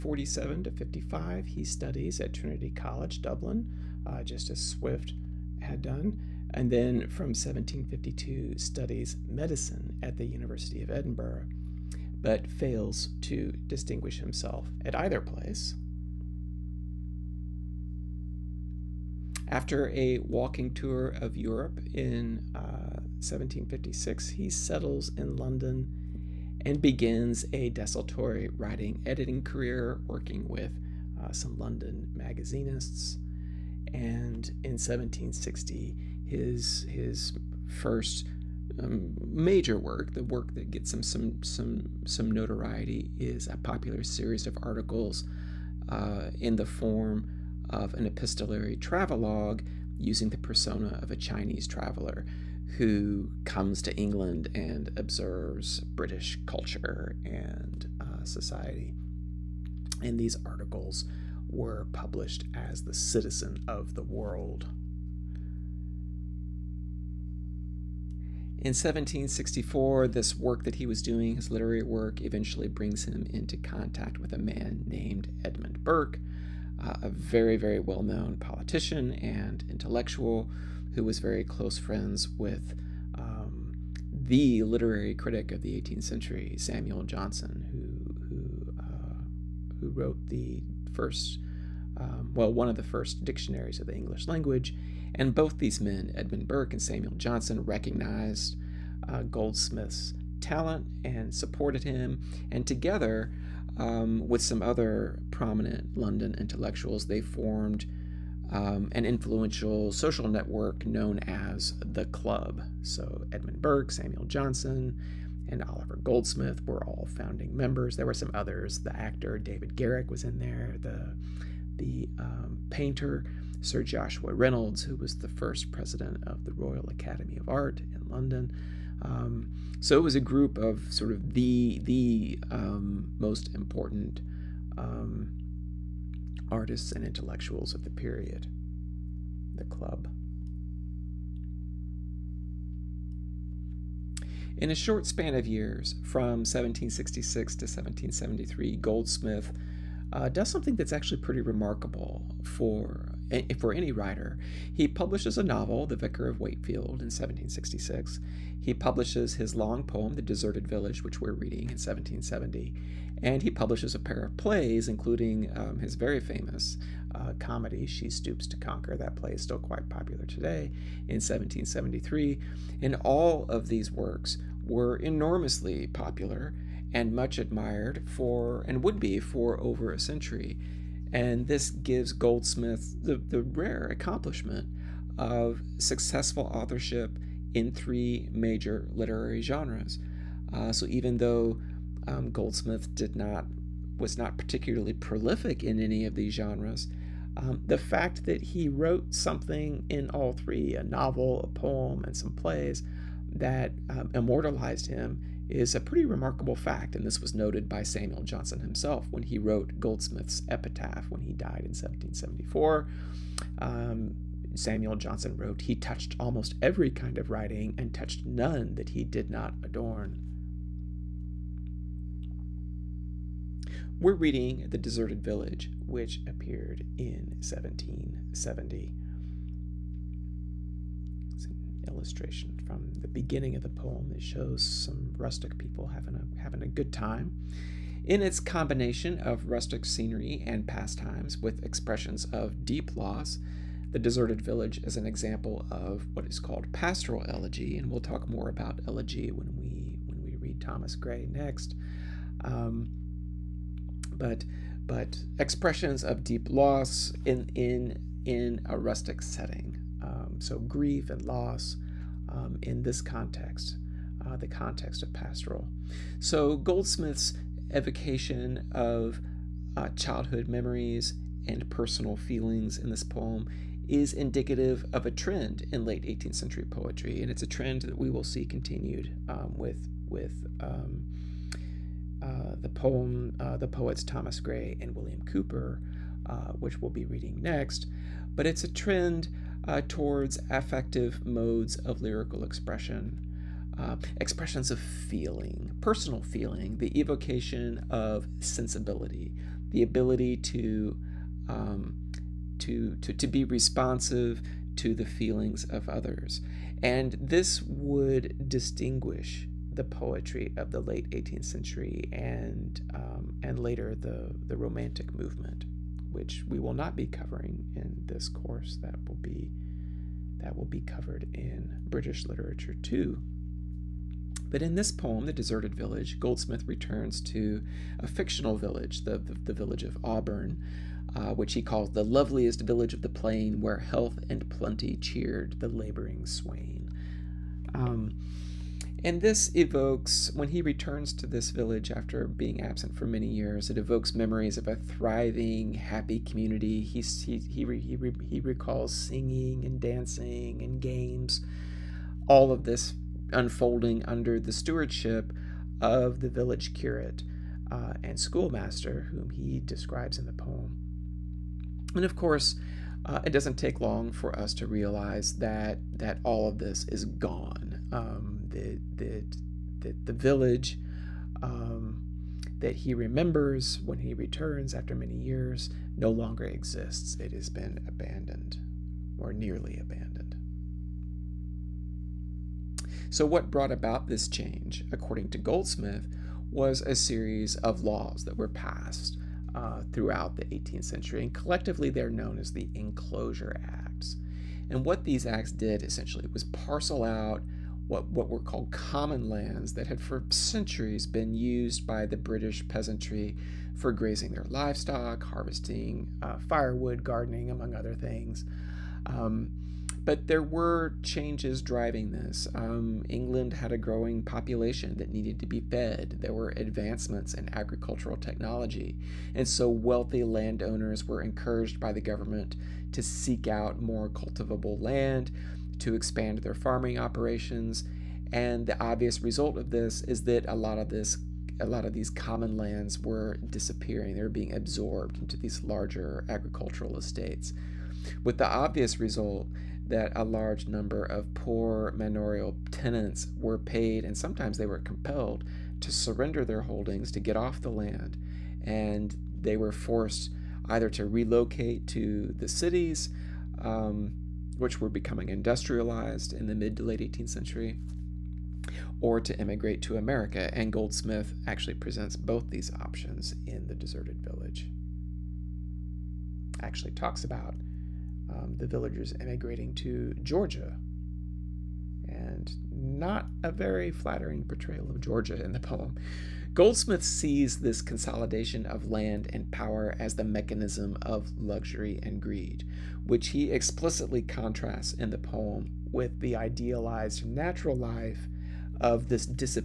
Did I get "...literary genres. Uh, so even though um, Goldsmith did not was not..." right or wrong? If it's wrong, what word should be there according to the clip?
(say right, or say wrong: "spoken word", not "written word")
right.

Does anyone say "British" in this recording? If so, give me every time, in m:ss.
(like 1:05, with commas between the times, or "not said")
0:55, 5:21, 6:42.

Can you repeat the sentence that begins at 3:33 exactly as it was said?
Um, Samuel Johnson wrote, He touched almost every kind of writing and touched none that he did not adorn.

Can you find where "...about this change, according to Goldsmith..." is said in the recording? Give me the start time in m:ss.
6:23.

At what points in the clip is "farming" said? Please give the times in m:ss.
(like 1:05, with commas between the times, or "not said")
7:06.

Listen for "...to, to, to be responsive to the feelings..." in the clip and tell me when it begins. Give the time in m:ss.
5:02.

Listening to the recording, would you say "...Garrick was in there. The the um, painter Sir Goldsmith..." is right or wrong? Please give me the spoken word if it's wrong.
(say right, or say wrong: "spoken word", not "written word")
wrong: "Joshua", not "Goldsmith".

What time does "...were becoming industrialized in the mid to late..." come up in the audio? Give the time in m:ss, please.
7:34.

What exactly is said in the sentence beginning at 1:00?
And these articles were published as the citizen of the world.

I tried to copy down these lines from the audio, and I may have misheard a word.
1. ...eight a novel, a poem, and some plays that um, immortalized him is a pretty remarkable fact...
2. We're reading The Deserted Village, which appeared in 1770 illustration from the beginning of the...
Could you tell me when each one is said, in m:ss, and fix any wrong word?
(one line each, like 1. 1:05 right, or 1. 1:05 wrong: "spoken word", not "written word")
1. 3:20 wrong: "three", not "eight"
2. 3:43 right.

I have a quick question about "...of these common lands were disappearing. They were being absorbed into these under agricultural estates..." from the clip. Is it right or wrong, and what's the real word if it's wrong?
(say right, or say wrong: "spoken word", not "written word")
wrong: "larger", not "under".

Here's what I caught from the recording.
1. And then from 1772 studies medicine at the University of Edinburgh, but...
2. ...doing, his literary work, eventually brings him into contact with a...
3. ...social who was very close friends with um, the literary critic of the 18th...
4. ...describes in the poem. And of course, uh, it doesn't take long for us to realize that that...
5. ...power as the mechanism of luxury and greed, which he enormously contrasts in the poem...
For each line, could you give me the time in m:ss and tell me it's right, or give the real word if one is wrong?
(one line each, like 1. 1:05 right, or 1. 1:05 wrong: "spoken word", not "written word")
1. 0:06 wrong: "1752", not "1772"
2. 1:11 right
3. 1:19 wrong: "intellectual", not "social"
4. 5:59 right
5. 7:59 wrong: "explicitly", not "enormously".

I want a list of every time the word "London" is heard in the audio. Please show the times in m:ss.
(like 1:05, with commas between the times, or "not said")
0:25, 0:31, 1:45, 2:08.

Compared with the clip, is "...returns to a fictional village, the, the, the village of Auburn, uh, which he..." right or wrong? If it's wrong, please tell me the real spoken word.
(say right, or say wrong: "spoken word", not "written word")
right.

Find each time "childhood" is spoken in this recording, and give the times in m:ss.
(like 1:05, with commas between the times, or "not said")
4:29.